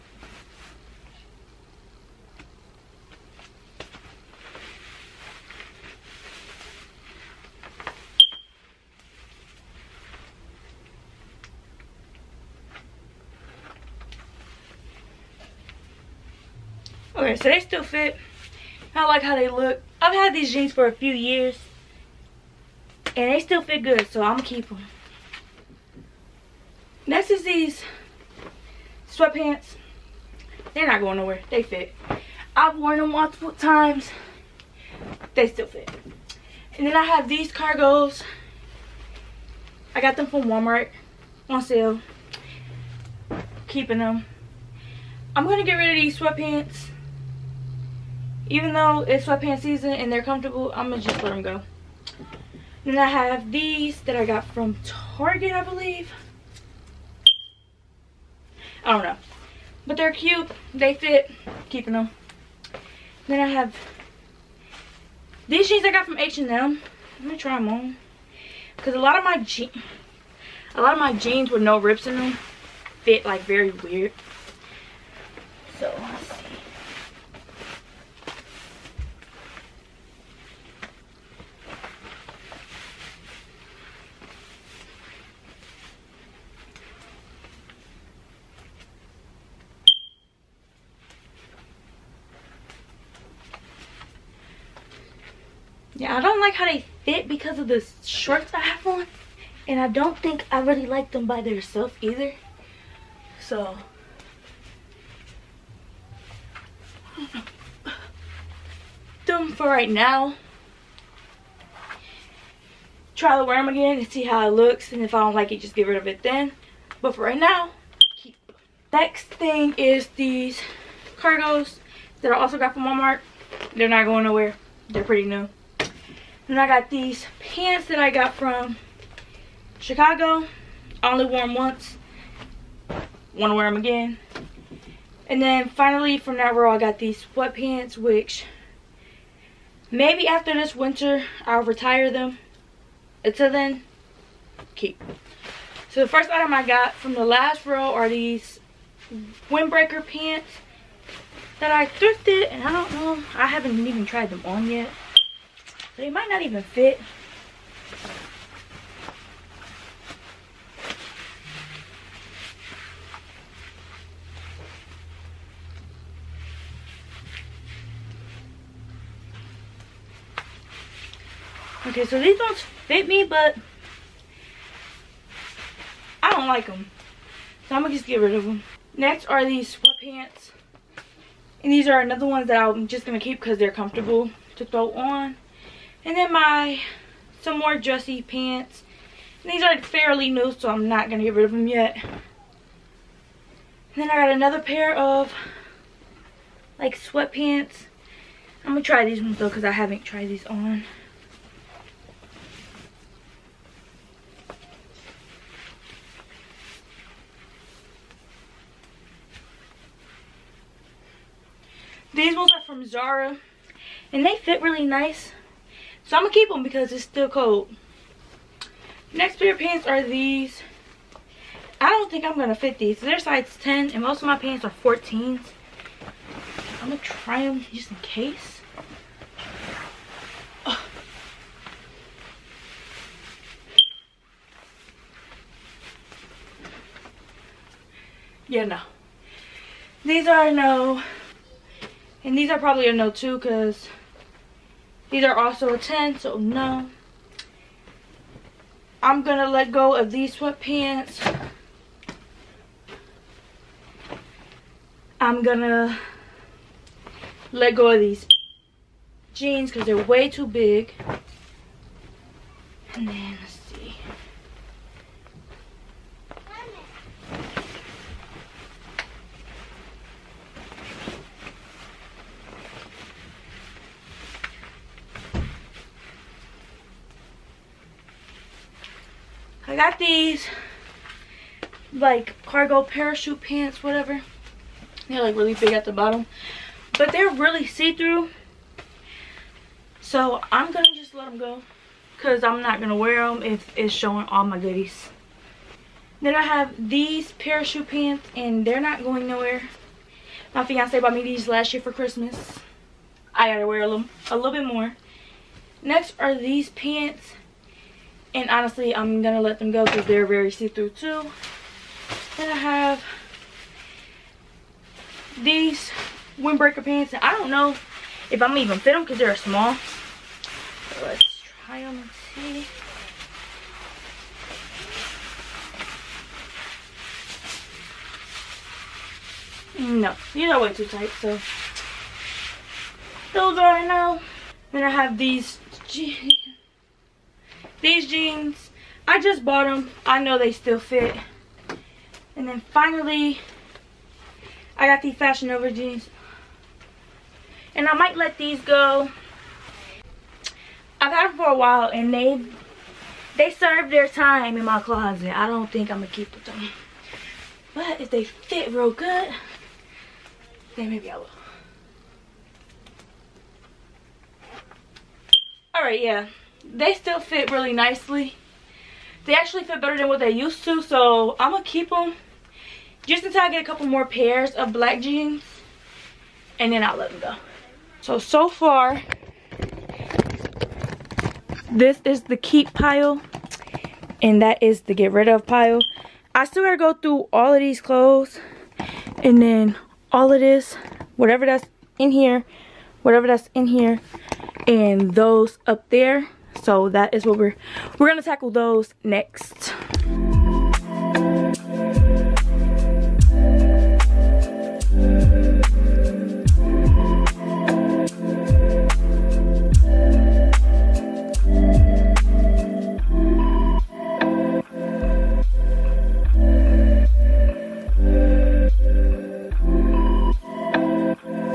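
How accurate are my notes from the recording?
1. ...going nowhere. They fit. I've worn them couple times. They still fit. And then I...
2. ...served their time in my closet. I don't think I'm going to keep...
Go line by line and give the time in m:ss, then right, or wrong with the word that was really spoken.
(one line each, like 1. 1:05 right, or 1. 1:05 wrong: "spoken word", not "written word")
1. 0:30 wrong: "multiple", not "couple"
2. 5:53 right.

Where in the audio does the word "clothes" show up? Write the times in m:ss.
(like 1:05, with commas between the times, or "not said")
6:27.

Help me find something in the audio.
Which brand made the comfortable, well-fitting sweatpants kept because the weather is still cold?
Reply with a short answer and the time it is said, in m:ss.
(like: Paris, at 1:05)
Zara, at 3:32.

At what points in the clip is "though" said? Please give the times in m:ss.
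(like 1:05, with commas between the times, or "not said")
0:48, 3:19.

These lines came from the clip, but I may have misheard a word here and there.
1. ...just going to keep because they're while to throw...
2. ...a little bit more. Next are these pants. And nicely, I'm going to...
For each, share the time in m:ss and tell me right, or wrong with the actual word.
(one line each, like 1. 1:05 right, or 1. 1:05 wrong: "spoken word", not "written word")
1. 3:02 wrong: "comfortable", not "while"
2. 5:04 wrong: "honestly", not "nicely".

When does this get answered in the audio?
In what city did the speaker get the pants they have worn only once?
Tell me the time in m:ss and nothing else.
2:09.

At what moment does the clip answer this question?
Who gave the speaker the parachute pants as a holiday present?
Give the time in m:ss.
5:00.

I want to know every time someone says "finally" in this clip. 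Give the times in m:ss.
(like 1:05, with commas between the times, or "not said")
2:15, 5:42.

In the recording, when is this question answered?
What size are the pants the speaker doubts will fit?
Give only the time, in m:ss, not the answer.
3:43.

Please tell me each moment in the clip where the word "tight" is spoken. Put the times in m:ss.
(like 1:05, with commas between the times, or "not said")
5:30.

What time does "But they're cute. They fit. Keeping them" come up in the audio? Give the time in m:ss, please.
0:59.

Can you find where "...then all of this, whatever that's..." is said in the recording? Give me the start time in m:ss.
6:29.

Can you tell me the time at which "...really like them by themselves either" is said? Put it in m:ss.
1:40.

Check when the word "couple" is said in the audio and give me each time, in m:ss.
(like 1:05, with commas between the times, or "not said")
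6:13.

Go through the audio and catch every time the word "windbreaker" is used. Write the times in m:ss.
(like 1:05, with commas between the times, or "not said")
2:29, 5:16.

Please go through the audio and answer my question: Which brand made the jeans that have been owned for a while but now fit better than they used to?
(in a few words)
Fashion Nova.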